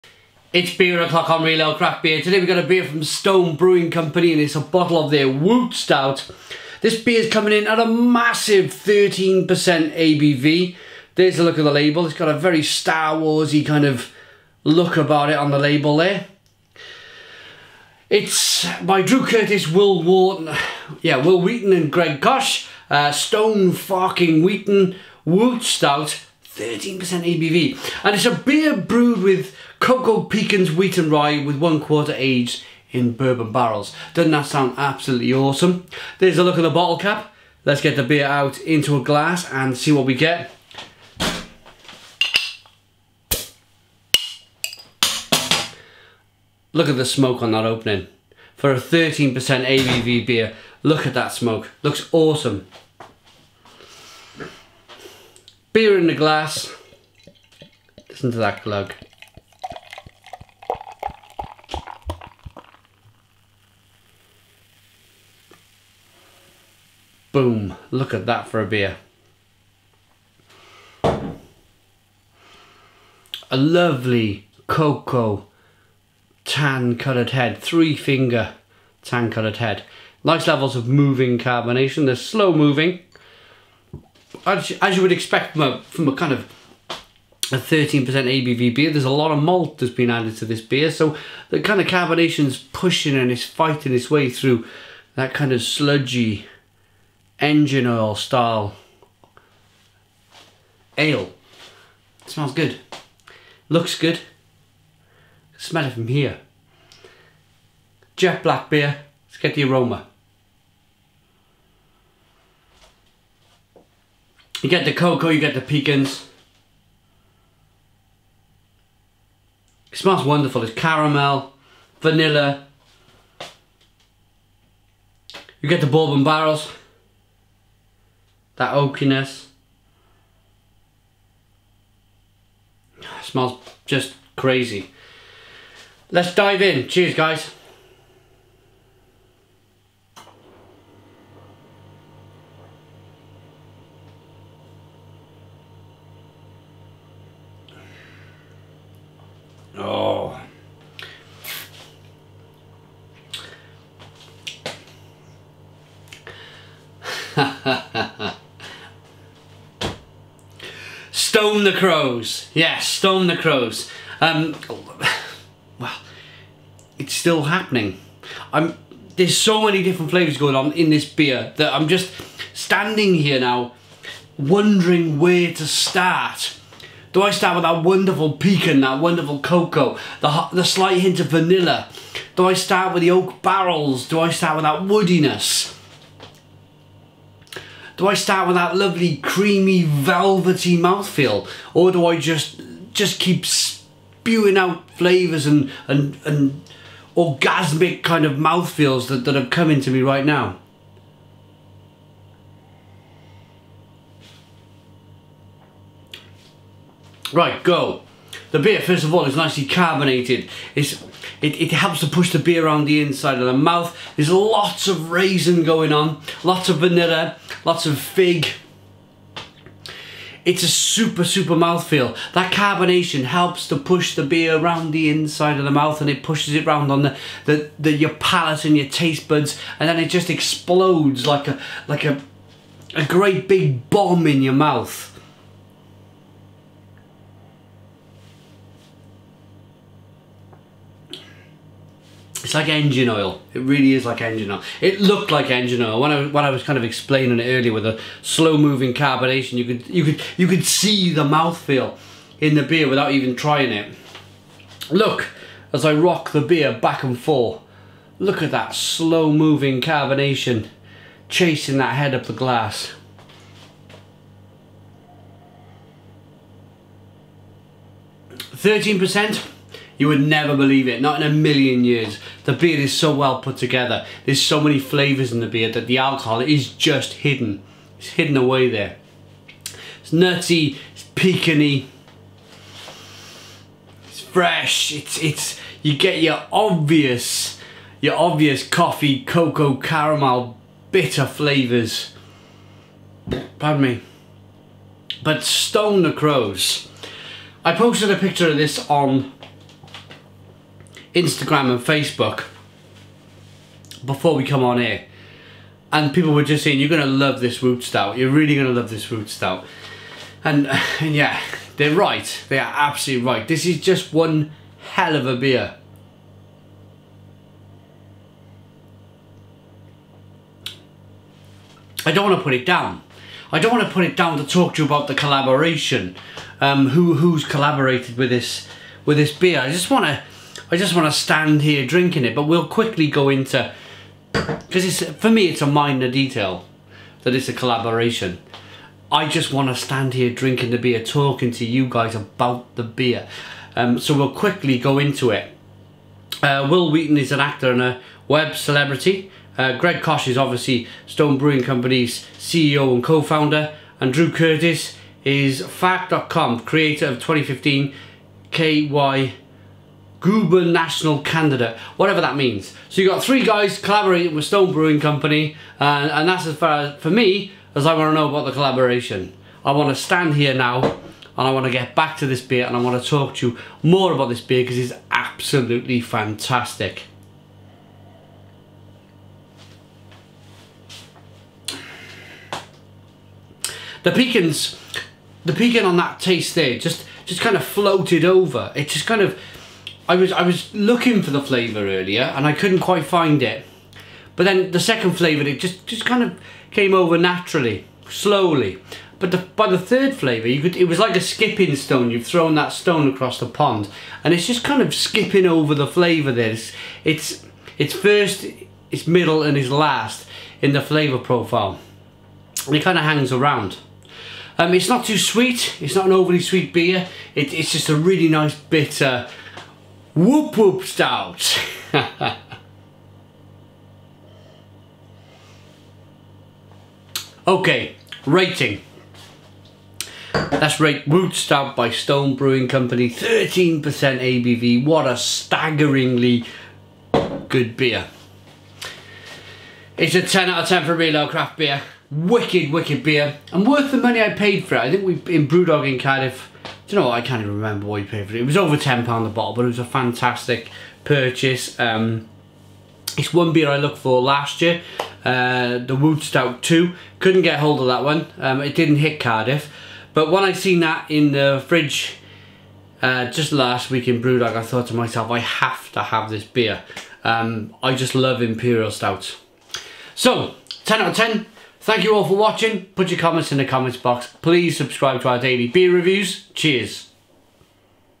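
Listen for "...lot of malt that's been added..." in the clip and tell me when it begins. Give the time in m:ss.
1:29.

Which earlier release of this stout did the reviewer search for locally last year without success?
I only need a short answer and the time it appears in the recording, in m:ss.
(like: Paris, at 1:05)
Woot Stout 2, at 7:35.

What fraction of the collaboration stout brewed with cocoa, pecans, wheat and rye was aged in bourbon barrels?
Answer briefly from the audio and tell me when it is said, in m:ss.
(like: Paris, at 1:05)
one quarter, at 0:31.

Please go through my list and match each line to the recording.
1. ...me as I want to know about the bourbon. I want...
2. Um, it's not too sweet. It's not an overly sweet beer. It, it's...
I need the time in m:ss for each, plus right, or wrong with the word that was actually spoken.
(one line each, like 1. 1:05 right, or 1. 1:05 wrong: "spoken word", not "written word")
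1. 6:07 wrong: "collaboration", not "bourbon"
2. 6:54 right.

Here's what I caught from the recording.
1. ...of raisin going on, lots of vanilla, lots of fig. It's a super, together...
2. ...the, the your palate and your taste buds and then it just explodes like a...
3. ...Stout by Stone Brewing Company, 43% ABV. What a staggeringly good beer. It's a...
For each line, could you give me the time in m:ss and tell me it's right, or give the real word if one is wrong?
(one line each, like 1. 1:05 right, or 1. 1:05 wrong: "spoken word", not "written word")
1. 3:34 wrong: "super", not "together"
2. 3:47 right
3. 7:11 wrong: "13", not "43".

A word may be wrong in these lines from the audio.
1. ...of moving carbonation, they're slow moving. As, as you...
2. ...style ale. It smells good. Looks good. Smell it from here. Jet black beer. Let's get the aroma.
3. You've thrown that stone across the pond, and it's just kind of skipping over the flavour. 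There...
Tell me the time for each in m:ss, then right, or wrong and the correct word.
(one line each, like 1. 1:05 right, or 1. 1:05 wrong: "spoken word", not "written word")
1. 1:20 right
2. 1:38 right
3. 6:42 right.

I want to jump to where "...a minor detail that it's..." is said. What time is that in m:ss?
5:35.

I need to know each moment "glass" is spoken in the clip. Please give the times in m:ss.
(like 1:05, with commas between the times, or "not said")
0:39, 0:56, 4:22.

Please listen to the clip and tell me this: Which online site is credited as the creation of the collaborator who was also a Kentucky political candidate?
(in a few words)
Fark.com.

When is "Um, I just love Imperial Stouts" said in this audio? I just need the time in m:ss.
7:47.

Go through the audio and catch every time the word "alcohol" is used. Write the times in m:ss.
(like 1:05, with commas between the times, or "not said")
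4:35.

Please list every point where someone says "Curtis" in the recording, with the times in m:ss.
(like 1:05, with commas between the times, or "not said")
0:19, 5:54.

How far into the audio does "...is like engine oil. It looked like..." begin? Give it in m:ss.
4:03.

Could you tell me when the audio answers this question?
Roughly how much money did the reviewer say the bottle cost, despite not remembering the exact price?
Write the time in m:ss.
7:28.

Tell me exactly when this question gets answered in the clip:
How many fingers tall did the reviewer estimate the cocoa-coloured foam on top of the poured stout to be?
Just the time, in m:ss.
1:17.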